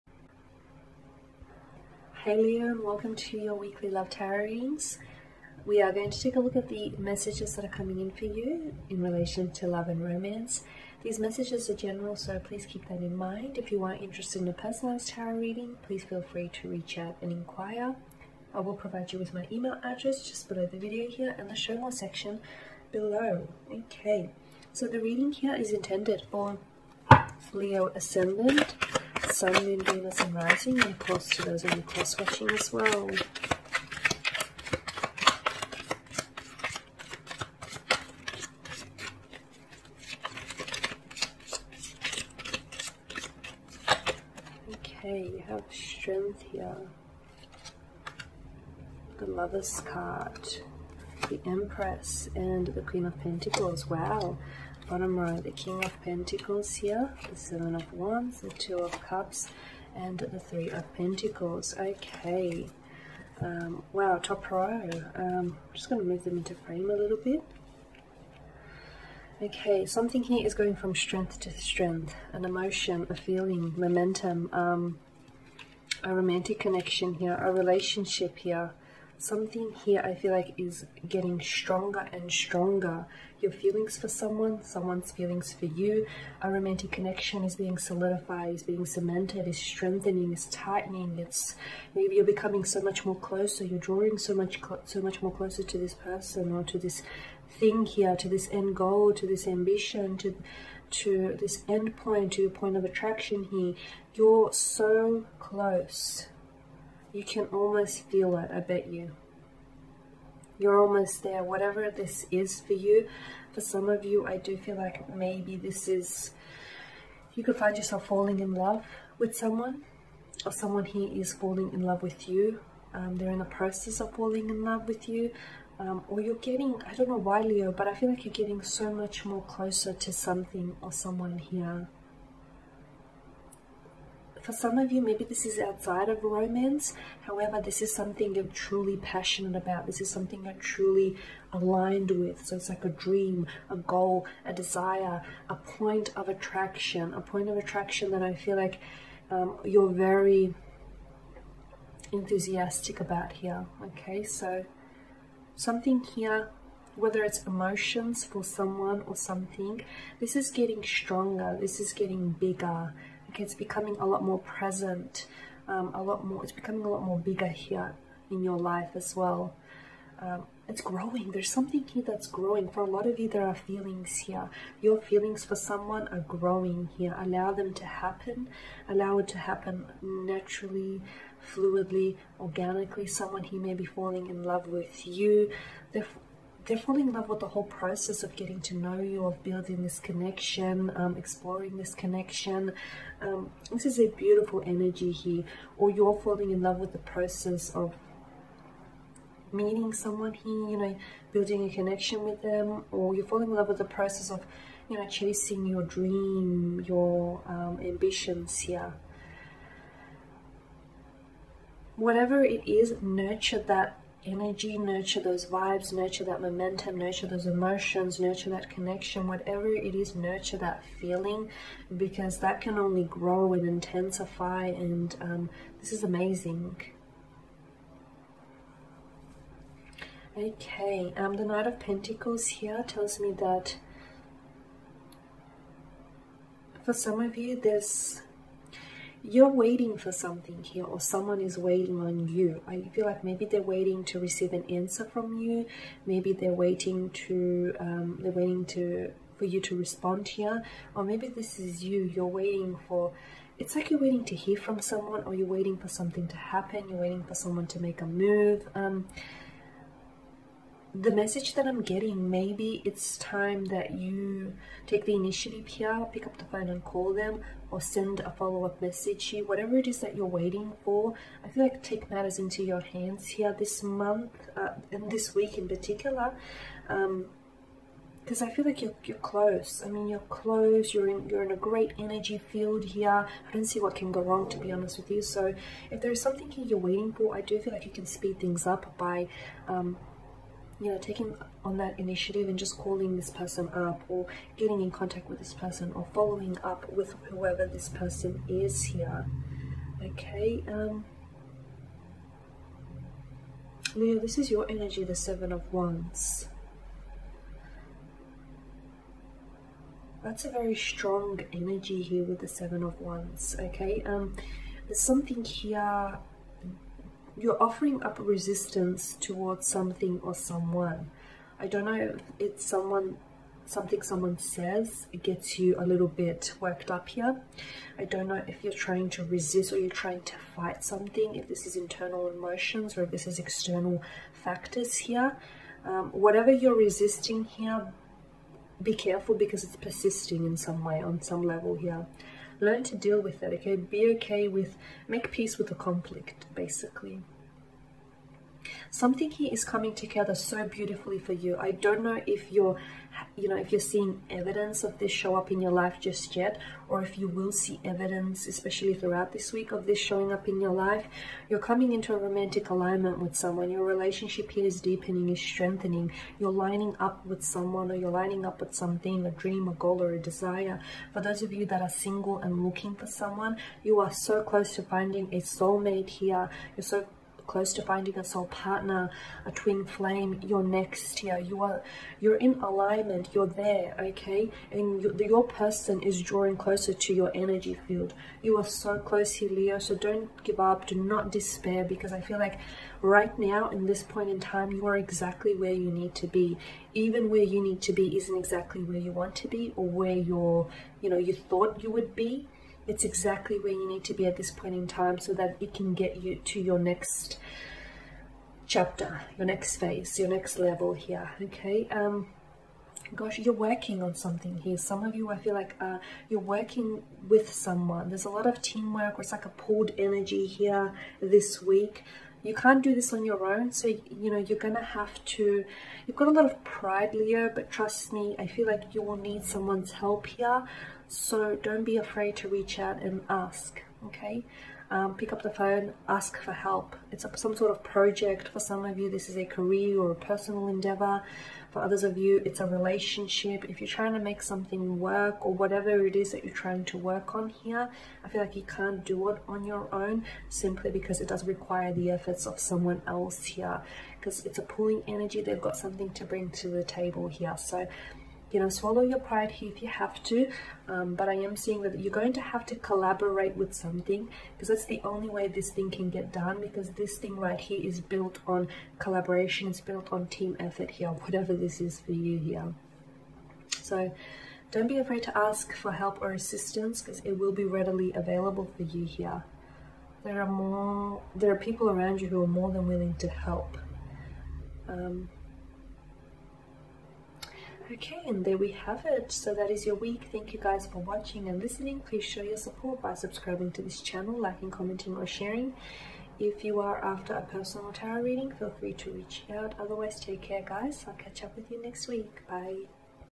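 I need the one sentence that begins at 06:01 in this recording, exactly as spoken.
You're coming into a romantic alignment with someone.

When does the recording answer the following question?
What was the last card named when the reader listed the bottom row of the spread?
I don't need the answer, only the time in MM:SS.
01:00.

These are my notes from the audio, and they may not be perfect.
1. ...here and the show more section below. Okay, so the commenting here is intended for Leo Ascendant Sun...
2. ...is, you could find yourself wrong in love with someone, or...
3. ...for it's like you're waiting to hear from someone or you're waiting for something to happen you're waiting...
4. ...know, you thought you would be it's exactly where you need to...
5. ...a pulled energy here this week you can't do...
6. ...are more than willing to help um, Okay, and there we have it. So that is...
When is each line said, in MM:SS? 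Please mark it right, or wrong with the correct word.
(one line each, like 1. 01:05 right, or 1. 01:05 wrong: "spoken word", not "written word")
1. 00:21 wrong: "reading", not "commenting"
2. 01:55 wrong: "falling", not "wrong"
3. 04:12 right
4. 06:41 right
5. 06:59 right
6. 08:02 right.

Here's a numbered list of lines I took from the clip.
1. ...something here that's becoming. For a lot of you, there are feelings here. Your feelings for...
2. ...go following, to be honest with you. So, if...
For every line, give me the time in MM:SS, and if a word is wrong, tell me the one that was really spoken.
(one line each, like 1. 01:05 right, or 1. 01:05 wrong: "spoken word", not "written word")
1. 02:51 wrong: "growing", not "becoming"
2. 04:44 wrong: "wrong", not "following".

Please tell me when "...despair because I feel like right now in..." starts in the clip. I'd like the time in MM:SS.
06:31.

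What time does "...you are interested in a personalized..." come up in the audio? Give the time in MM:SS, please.
00:13.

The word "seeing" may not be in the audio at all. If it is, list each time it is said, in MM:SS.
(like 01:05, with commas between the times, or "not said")
05:53, 07:41.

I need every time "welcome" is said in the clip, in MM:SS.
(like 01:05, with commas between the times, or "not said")
00:02.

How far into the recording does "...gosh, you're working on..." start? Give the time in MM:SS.
06:53.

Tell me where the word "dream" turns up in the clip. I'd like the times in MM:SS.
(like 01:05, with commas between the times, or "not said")
02:22, 03:25, 06:09.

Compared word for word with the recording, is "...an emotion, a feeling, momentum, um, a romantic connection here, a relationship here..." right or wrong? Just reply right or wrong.
right.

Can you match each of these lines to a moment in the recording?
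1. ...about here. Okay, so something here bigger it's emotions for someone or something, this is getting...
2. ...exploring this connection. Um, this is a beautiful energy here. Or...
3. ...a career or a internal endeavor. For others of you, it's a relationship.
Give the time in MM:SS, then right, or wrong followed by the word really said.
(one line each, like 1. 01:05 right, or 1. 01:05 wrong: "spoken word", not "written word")
1. 02:32 wrong: "whether", not "bigger"
2. 03:11 right
3. 07:19 wrong: "personal", not "internal".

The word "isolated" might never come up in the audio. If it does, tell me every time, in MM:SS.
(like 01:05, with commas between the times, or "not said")
not said.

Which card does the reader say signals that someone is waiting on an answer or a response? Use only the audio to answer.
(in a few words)
Knight of Pentacles.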